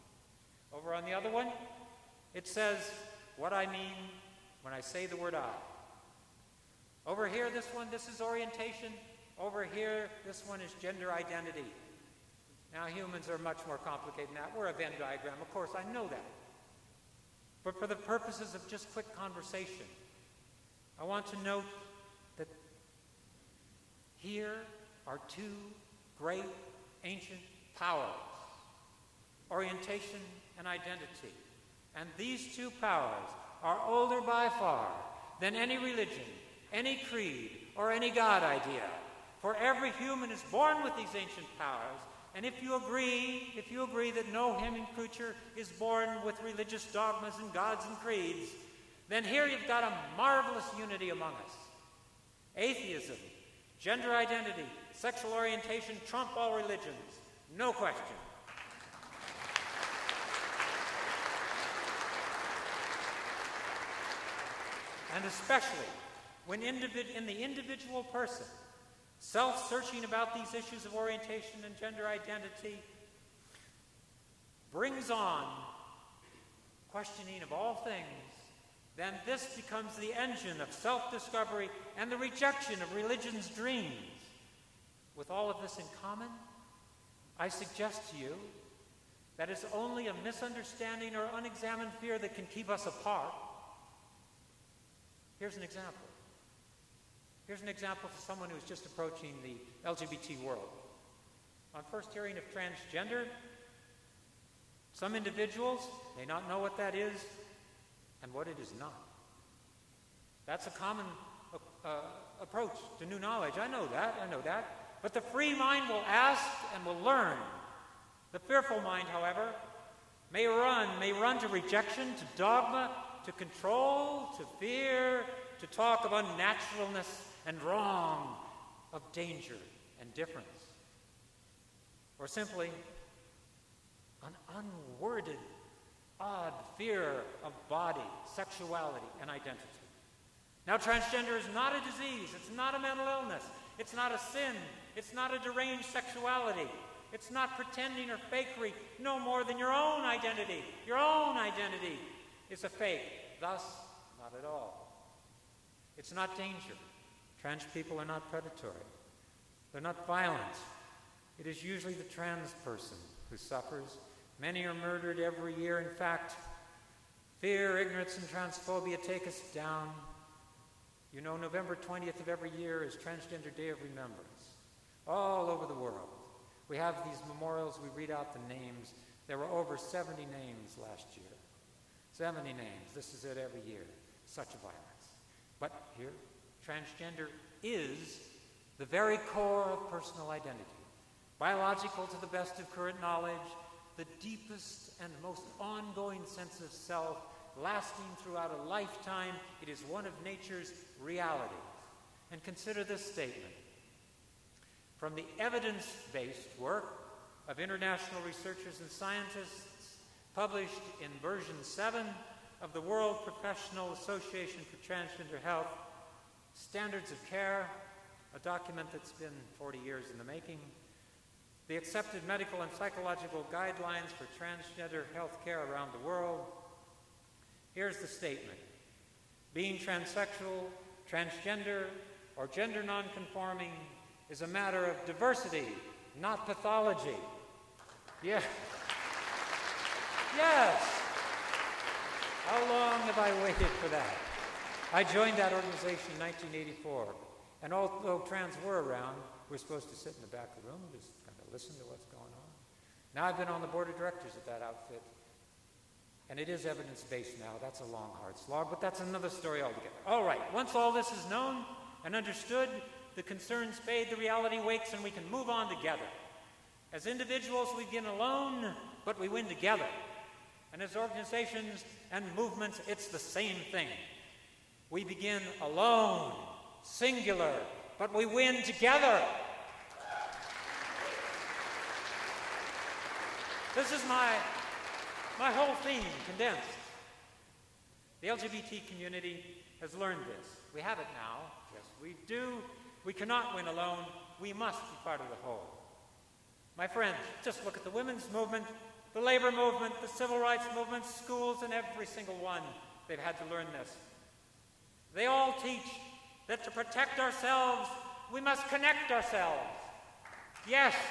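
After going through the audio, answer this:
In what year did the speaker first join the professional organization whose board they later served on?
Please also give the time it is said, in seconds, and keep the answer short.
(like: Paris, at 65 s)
1984, at 246 s.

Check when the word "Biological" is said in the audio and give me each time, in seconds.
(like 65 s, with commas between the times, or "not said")
191 s.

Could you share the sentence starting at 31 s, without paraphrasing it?
And these two powers are older by far than any religion, any creed, or any God idea.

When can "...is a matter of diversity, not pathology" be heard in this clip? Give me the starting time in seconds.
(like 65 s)
234 s.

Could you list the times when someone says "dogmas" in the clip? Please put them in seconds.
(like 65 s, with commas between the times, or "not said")
46 s, 122 s.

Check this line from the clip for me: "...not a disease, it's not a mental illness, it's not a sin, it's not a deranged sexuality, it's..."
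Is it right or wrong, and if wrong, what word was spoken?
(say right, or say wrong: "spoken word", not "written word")
right.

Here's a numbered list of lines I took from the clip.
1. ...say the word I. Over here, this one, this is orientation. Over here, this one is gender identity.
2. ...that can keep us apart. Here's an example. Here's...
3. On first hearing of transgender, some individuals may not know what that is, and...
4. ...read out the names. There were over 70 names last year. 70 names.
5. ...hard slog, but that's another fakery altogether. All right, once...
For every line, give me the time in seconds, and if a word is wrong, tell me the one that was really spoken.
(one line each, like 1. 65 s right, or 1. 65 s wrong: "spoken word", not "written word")
1. 4 s right
2. 92 s right
3. 101 s right
4. 177 s right
5. 258 s wrong: "story", not "fakery".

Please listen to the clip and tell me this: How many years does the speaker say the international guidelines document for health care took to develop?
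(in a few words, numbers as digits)
40 years.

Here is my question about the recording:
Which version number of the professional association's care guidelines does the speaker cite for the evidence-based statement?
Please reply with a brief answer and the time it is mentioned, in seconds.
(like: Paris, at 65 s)
7, at 211 s.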